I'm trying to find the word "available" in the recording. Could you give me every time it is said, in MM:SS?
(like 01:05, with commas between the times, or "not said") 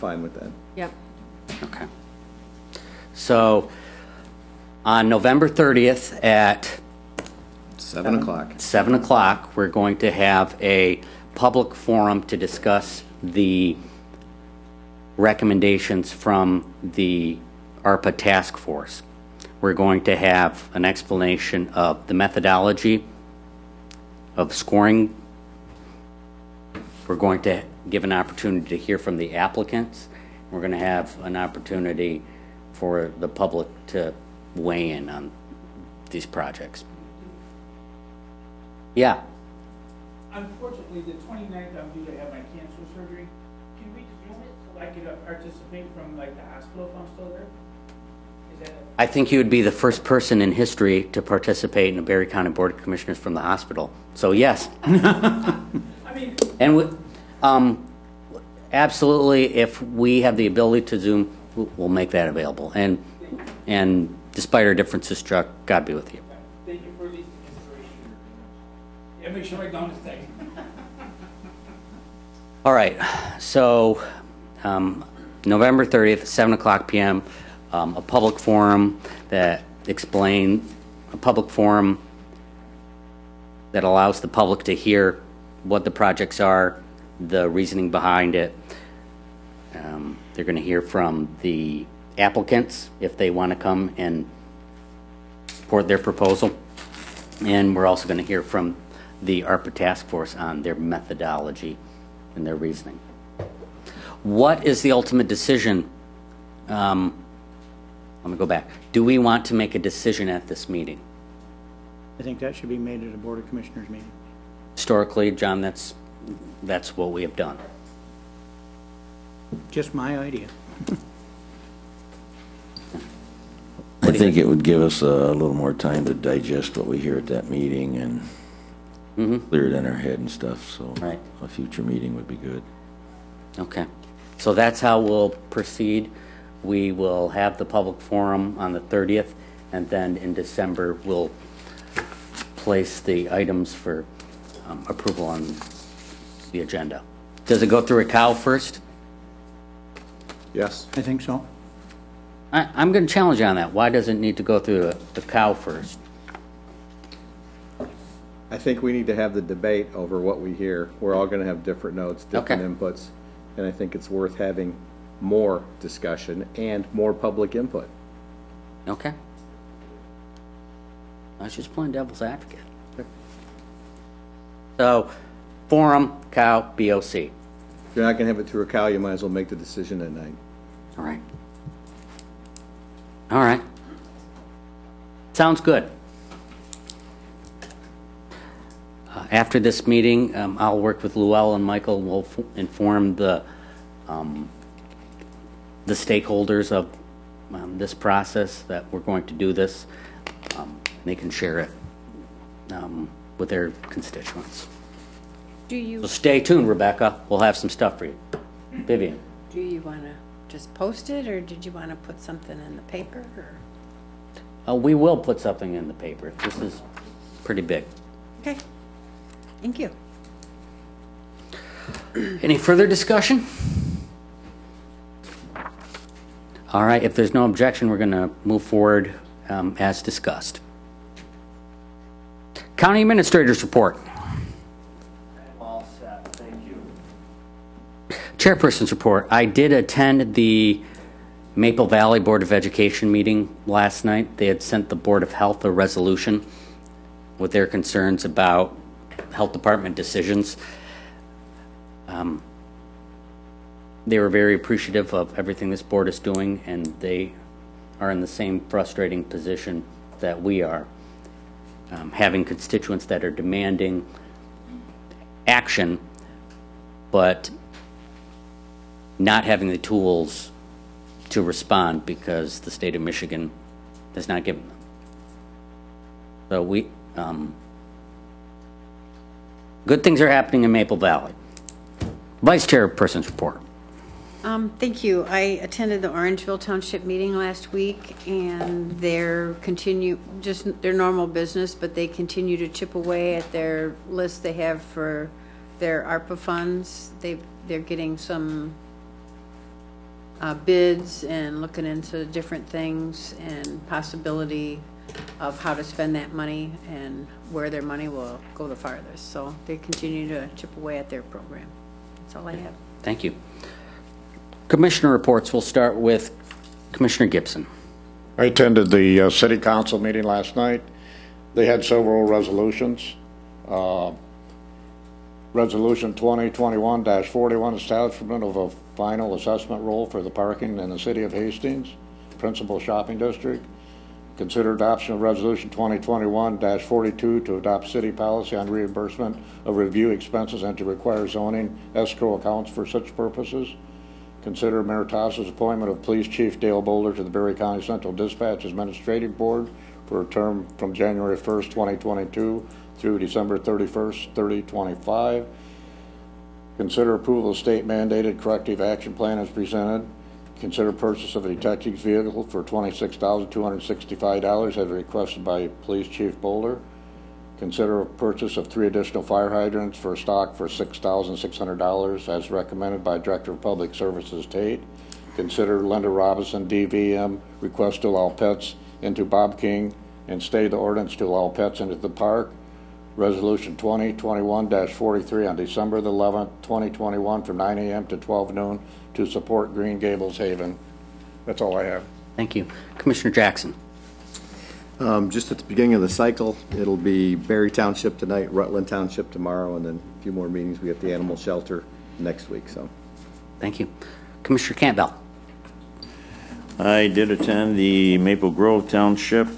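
01:02.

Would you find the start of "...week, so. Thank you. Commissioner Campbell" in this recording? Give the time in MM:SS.
06:42.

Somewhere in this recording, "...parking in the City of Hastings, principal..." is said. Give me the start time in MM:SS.
05:30.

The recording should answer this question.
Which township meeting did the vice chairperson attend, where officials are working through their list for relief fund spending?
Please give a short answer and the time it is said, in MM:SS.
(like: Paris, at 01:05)
Orangeville Township, at 04:46.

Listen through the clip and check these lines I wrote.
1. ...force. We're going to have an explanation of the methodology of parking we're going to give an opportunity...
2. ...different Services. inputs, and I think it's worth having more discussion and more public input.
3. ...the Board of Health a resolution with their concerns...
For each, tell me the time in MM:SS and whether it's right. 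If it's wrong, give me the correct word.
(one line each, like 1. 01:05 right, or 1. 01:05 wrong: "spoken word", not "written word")
1. 00:18 wrong: "scoring", not "parking"
2. 02:42 wrong: "Okay", not "Services"
3. 04:04 right.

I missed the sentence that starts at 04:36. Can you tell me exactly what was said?
So we, um, good things are happening in Maple Valley.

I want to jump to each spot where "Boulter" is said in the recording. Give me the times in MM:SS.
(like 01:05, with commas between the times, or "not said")
05:46, 06:06.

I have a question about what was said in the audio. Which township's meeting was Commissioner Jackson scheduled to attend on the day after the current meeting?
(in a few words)
Rutland Township.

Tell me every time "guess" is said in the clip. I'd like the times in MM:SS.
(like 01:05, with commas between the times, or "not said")
not said.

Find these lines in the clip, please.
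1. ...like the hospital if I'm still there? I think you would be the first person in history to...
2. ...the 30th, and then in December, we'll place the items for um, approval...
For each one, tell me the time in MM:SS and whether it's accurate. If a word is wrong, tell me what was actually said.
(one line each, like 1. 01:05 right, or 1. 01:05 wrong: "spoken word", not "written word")
1. 00:46 right
2. 02:18 right.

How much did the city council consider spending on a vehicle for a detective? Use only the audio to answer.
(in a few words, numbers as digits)
$26,265.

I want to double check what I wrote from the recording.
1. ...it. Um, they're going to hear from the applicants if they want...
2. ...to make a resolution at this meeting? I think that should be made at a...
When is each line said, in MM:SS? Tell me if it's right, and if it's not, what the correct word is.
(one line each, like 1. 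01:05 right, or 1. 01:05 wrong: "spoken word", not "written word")
1. 01:28 right
2. 01:49 wrong: "decision", not "resolution".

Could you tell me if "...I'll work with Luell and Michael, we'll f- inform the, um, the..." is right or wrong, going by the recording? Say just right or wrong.
right.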